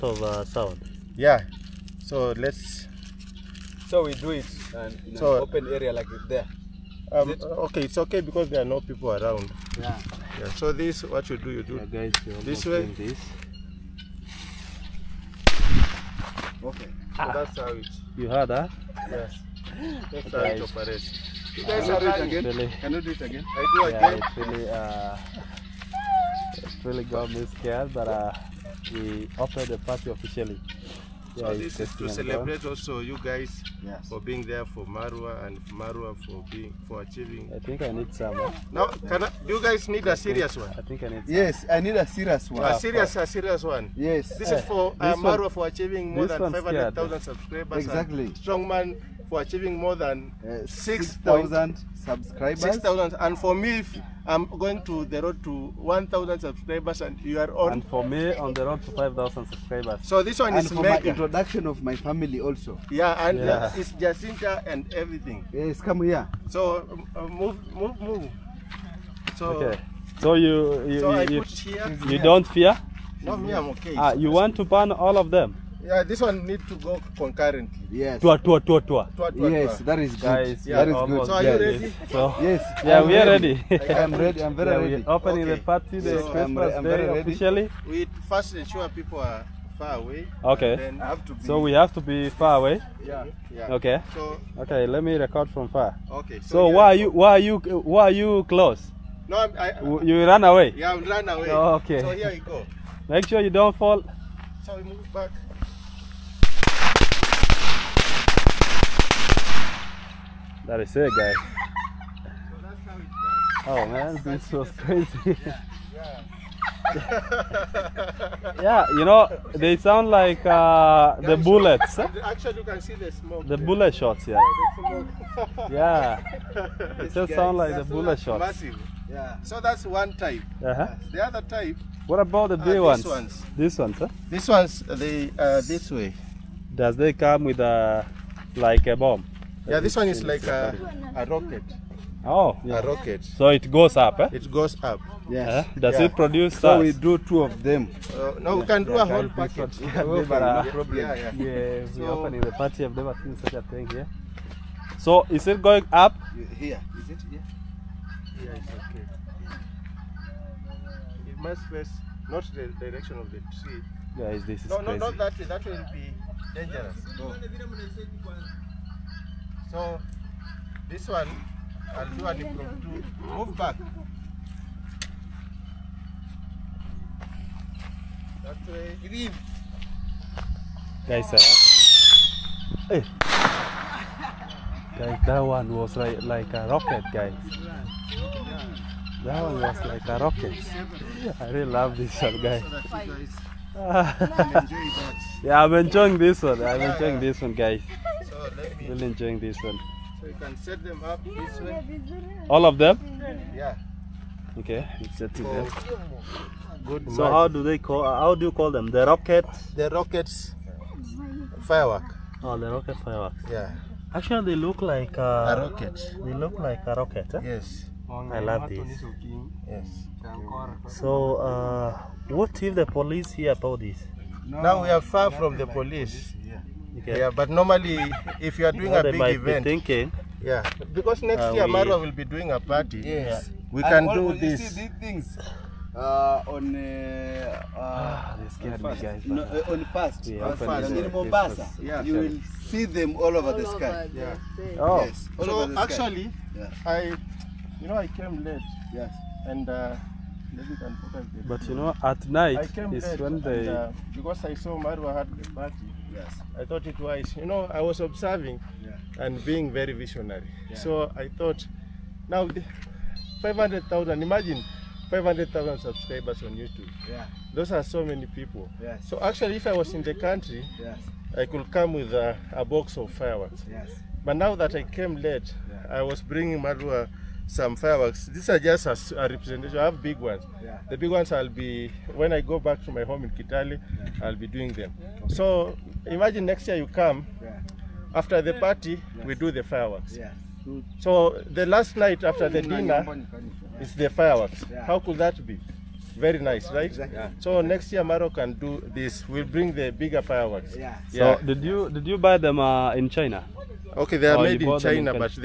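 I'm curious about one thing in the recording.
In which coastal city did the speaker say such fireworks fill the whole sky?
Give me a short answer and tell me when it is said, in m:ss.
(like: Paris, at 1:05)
Mombasa, at 4:01.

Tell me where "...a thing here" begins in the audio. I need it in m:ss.
2:33.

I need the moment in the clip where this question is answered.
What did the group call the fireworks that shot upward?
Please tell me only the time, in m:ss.
3:32.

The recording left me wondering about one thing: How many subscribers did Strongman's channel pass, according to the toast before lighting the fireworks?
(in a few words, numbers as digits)
6,000.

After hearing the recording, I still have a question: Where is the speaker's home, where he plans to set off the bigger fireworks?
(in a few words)
Kitale.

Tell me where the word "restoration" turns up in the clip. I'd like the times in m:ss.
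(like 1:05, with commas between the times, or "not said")
not said.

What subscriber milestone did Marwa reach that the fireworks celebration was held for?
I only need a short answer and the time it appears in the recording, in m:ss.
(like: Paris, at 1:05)
500,000, at 0:46.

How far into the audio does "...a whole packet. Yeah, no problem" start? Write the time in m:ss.
2:29.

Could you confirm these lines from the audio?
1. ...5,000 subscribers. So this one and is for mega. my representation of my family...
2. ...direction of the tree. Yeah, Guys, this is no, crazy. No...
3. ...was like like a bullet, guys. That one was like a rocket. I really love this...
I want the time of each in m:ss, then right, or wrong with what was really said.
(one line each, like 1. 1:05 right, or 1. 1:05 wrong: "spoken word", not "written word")
1. 0:58 wrong: "introduction", not "representation"
2. 2:42 right
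3. 3:05 wrong: "rocket", not "bullet".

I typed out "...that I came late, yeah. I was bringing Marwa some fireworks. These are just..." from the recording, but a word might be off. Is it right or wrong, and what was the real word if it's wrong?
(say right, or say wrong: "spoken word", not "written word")
right.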